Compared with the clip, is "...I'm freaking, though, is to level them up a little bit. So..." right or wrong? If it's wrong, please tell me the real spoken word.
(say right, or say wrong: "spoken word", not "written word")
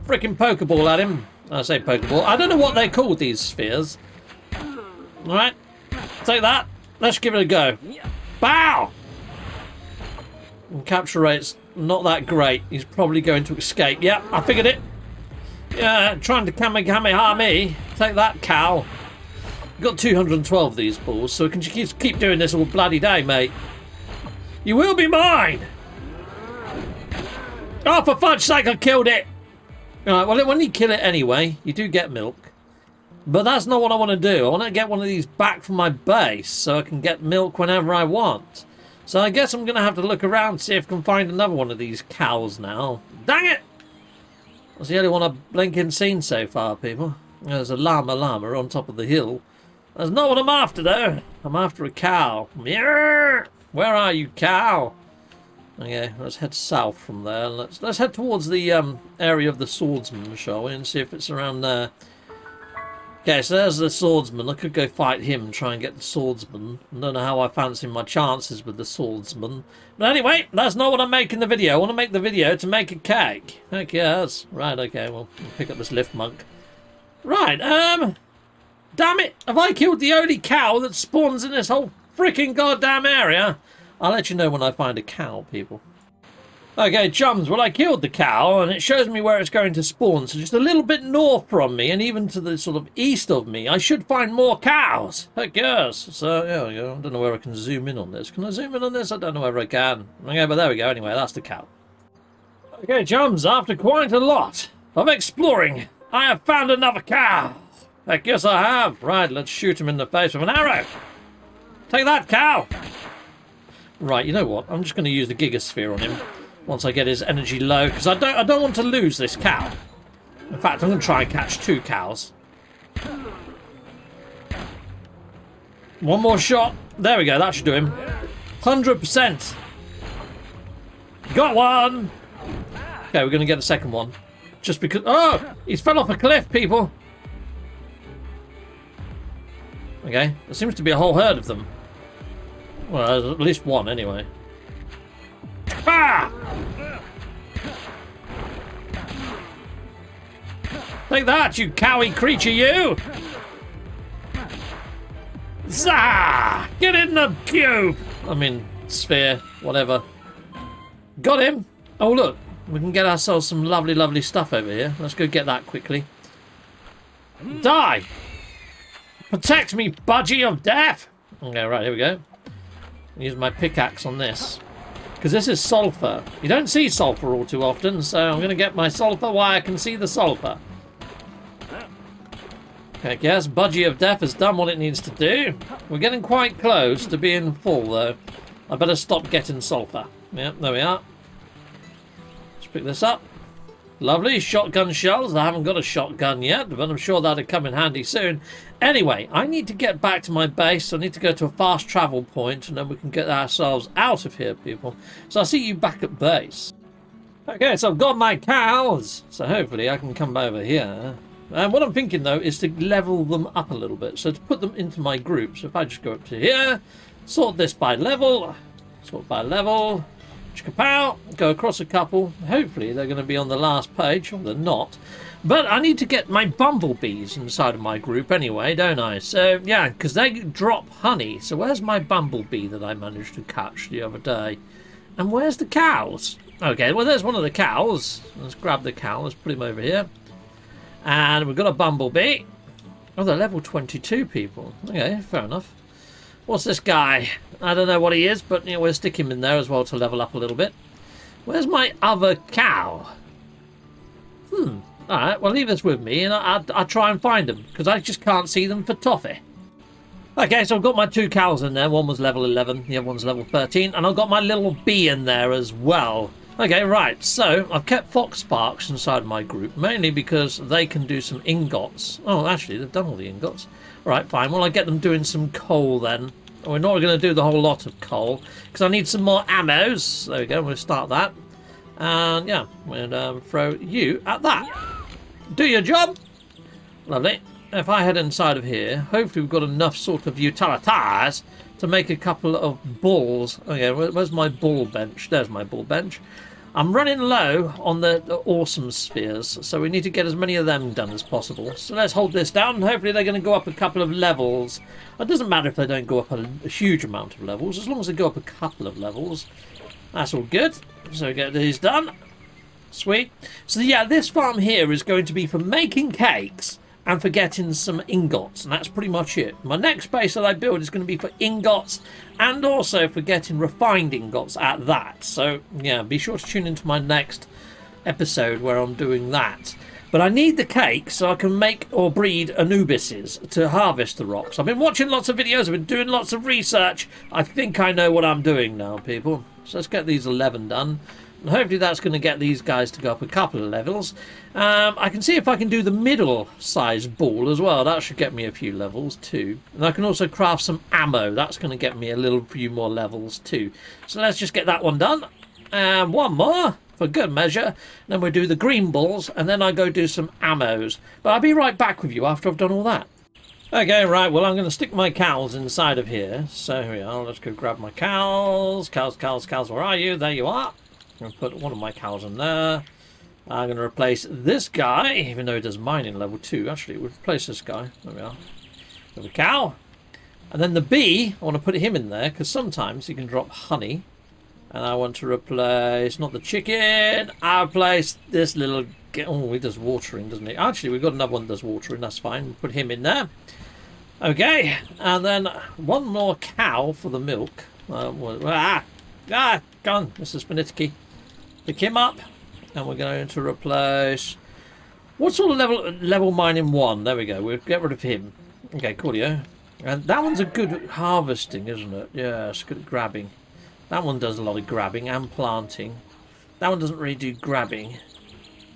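wrong: "thinking", not "freaking".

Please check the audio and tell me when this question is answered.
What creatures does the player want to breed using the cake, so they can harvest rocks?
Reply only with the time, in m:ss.
5:32.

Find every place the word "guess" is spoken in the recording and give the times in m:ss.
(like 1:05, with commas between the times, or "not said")
0:39, 1:35, 1:48, 3:03.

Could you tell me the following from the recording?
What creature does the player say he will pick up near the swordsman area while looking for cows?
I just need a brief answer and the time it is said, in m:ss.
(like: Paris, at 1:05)
Lifmunk, at 1:15.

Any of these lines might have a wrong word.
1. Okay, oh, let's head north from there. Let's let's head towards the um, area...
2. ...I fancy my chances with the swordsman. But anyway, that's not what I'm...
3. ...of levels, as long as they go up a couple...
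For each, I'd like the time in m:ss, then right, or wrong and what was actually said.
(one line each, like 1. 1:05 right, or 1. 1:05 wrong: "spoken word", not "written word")
1. 0:55 wrong: "south", not "north"
2. 1:07 right
3. 5:07 right.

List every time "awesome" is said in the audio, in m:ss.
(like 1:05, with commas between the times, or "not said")
4:58.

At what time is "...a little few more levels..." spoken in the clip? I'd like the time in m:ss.
5:52.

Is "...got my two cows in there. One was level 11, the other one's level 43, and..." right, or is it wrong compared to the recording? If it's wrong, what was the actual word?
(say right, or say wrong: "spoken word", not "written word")
wrong: "13", not "43".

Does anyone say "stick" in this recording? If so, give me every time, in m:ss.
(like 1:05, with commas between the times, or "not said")
4:08, 6:04.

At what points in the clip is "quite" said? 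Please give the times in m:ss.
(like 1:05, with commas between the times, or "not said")
1:43, 3:06.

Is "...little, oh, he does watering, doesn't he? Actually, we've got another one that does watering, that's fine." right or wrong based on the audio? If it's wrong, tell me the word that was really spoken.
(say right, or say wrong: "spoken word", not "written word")
right.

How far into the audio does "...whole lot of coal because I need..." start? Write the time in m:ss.
4:37.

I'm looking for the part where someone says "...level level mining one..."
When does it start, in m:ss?
6:45.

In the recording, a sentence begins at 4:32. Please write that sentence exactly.
Oh, actually, they've done all the ingots.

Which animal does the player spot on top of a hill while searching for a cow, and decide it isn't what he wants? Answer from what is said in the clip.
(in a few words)
llama.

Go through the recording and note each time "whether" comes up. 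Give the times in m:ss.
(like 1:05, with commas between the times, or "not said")
1:39.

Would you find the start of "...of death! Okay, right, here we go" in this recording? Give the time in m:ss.
2:50.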